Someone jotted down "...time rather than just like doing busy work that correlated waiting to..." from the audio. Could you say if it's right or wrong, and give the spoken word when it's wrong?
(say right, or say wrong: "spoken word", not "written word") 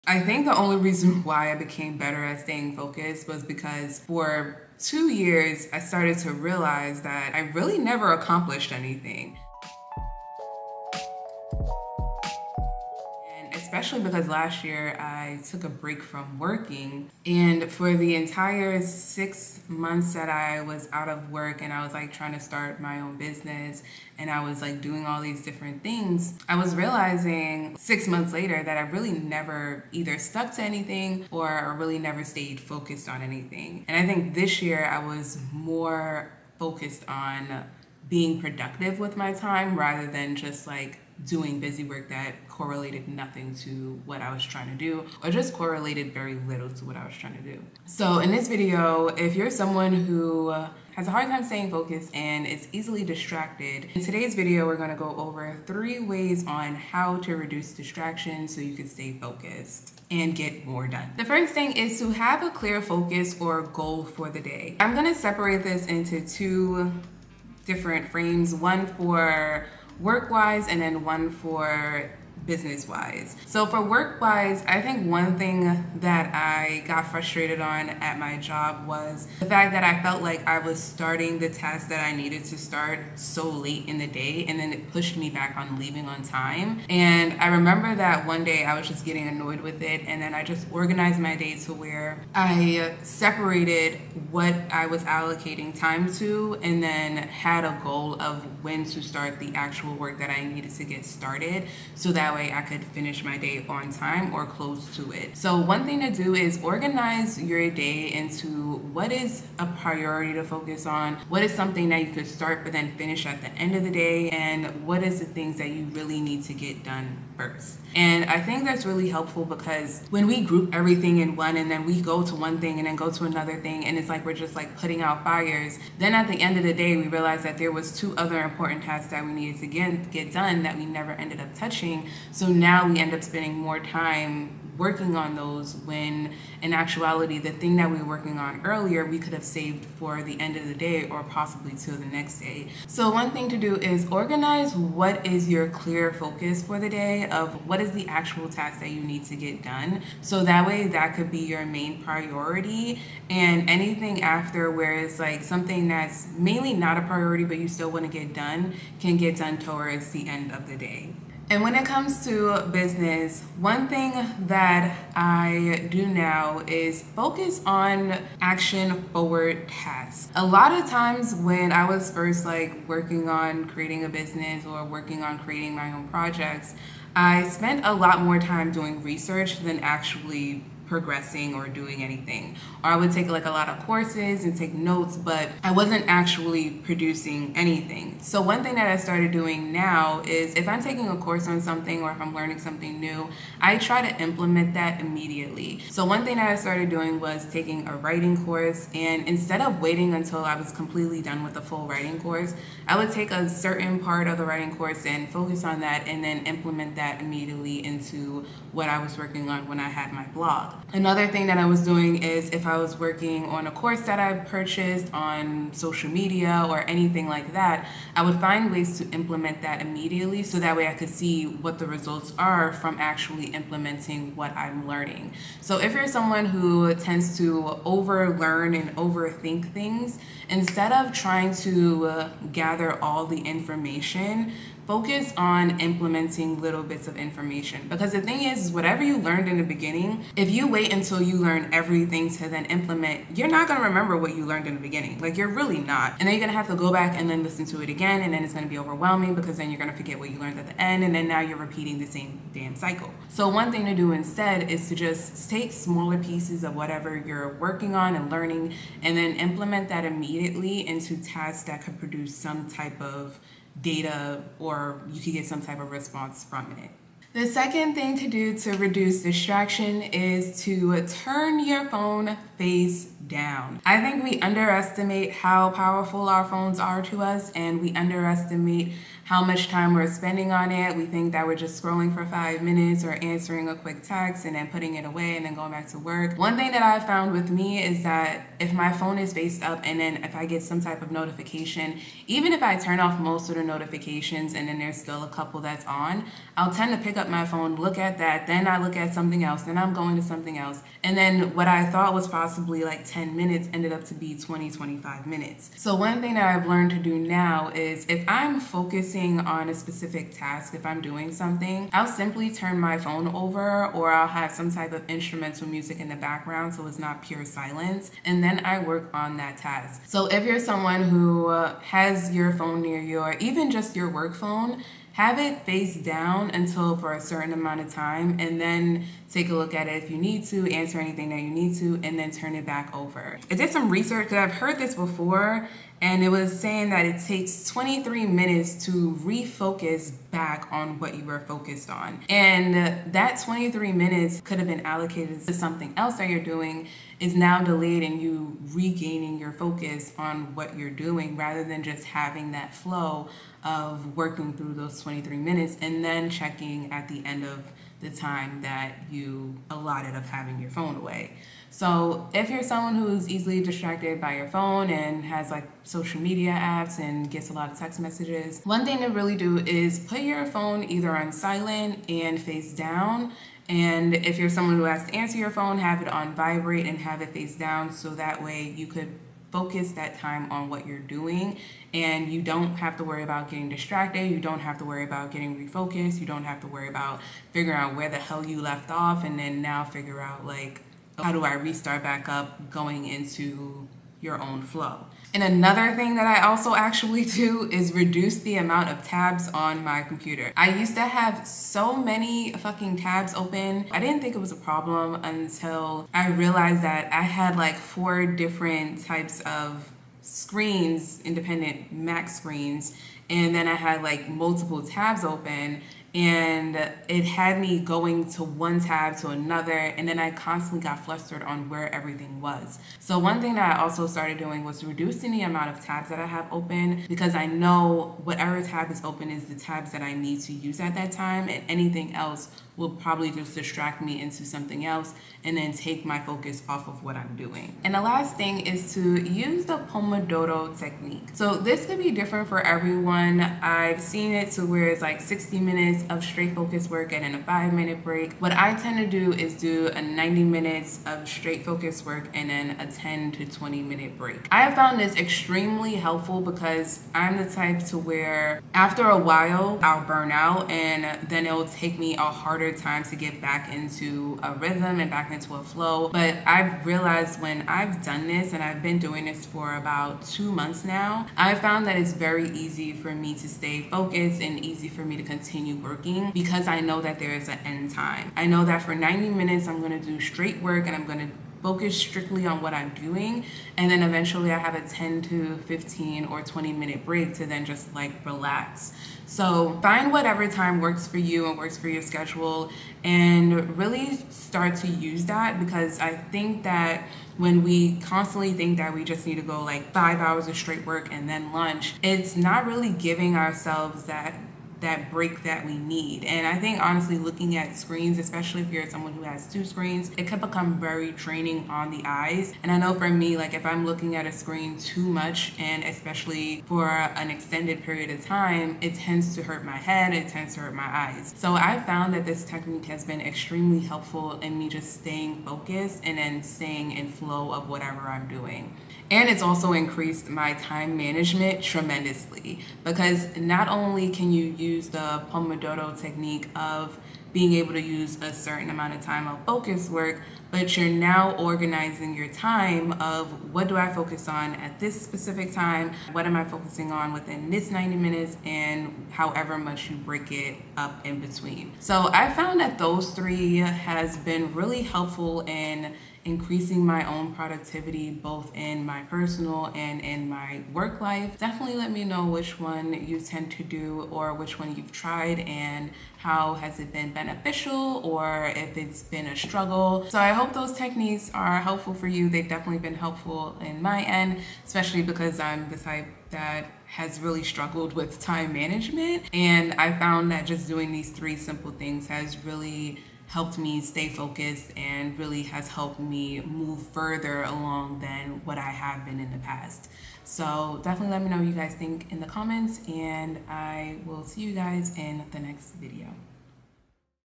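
wrong: "nothing", not "waiting".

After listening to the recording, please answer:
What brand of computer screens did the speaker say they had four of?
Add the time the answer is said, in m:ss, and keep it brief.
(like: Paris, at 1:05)
Mac, at 6:51.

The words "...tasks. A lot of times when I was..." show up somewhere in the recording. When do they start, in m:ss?
2:49.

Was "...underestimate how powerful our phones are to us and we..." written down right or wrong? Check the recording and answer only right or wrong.
right.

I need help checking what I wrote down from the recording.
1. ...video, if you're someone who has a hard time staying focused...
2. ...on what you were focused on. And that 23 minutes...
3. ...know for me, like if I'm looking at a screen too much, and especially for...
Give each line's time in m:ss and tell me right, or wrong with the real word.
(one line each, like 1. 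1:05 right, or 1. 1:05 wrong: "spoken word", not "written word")
1. 0:48 right
2. 5:40 right
3. 8:32 right.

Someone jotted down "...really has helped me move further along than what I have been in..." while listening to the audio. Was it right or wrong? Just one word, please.
right.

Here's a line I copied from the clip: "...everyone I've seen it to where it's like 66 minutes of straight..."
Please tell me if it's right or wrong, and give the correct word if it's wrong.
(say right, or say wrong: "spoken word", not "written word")
wrong: "60", not "66".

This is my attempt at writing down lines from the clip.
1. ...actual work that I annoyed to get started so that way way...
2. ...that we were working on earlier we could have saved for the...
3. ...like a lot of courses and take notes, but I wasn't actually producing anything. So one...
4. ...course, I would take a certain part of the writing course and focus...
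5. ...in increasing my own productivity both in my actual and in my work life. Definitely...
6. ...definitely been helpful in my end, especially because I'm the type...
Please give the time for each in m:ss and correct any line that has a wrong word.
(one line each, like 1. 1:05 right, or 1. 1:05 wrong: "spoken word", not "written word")
1. 1:39 wrong: "needed", not "annoyed"
2. 2:17 right
3. 3:03 right
4. 3:22 right
5. 9:15 wrong: "personal", not "actual"
6. 9:32 right.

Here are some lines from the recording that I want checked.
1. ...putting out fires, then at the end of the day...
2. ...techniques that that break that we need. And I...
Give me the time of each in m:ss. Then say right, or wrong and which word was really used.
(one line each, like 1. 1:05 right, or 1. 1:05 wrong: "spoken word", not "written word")
1. 2:04 right
2. 8:23 wrong: "ourselves", not "techniques".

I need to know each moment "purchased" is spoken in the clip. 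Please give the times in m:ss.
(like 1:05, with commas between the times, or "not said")
3:34.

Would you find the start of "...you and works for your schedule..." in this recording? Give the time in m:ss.
8:11.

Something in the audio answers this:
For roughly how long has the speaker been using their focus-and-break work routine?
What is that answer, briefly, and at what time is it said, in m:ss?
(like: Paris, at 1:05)
About 2 months, at 7:50.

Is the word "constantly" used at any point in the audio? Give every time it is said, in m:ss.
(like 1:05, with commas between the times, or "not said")
7:00, 8:18.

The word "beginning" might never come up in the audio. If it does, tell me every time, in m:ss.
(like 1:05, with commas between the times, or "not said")
3:59, 4:04.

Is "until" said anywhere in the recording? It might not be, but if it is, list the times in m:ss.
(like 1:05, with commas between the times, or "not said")
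3:20, 4:00, 5:26, 6:45.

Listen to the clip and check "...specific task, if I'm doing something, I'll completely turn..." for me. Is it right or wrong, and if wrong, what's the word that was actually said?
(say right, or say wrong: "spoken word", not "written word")
wrong: "simply", not "completely".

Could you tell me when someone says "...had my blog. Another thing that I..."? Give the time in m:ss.
3:29.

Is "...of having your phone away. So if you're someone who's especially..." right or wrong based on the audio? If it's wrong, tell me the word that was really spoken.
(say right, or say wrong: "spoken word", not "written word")
wrong: "easily", not "especially".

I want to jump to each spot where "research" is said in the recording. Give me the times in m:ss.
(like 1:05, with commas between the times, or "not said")
2:59, 5:33.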